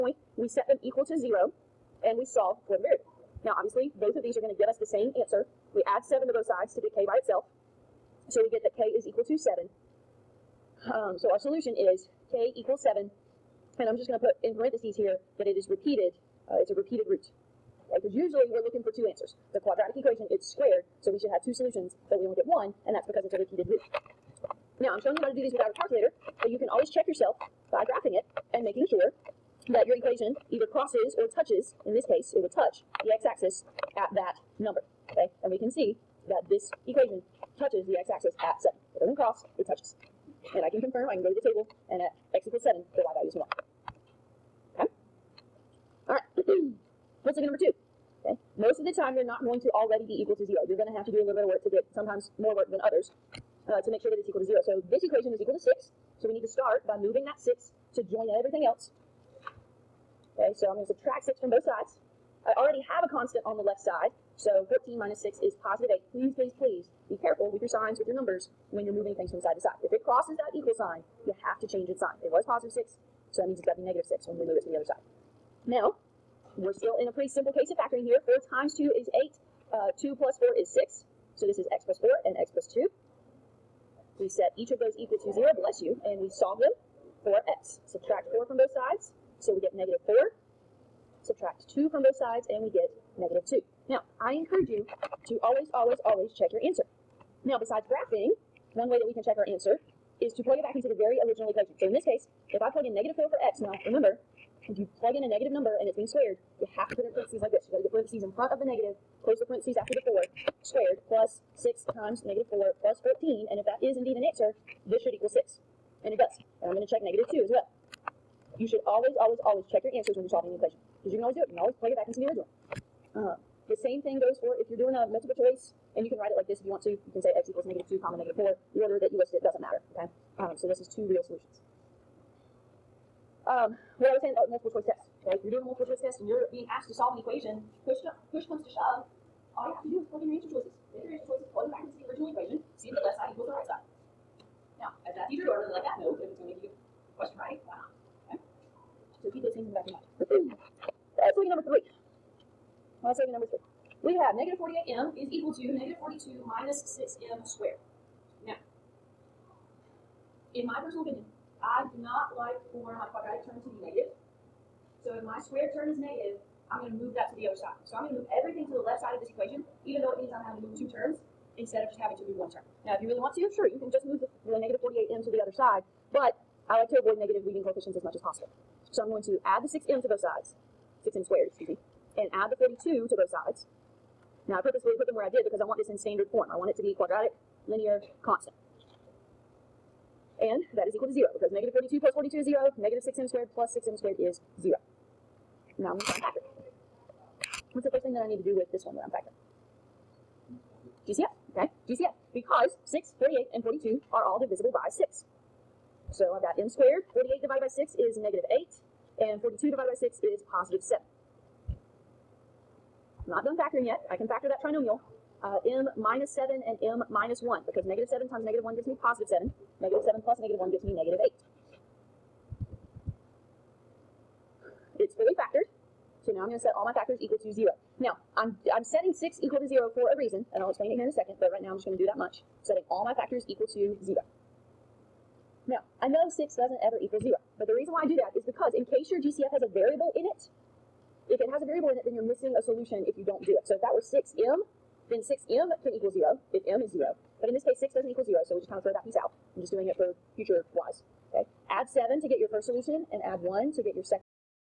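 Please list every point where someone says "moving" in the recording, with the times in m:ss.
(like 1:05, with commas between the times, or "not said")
0:56, 1:08.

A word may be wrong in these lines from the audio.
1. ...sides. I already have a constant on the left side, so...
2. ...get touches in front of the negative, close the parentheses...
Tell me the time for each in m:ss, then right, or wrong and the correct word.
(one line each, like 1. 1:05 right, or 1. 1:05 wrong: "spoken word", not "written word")
1. 1:01 right
2. 1:47 wrong: "parentheses", not "touches".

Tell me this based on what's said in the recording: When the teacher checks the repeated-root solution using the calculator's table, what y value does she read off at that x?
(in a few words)
1.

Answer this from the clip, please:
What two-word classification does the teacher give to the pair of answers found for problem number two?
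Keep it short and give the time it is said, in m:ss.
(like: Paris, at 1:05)
two real solutions, at 2:10.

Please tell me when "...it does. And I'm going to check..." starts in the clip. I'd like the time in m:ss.
1:56.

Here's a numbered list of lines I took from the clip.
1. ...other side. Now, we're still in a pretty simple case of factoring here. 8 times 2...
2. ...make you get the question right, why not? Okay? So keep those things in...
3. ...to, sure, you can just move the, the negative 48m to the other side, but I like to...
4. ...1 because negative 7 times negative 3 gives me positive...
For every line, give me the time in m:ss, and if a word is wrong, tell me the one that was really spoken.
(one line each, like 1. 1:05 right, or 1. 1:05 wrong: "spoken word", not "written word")
1. 1:14 wrong: "4", not "8"
2. 2:26 right
3. 2:53 right
4. 3:37 wrong: "1", not "3".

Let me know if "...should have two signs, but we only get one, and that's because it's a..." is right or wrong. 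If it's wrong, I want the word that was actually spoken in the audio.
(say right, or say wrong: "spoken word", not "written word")
wrong: "solutions", not "signs".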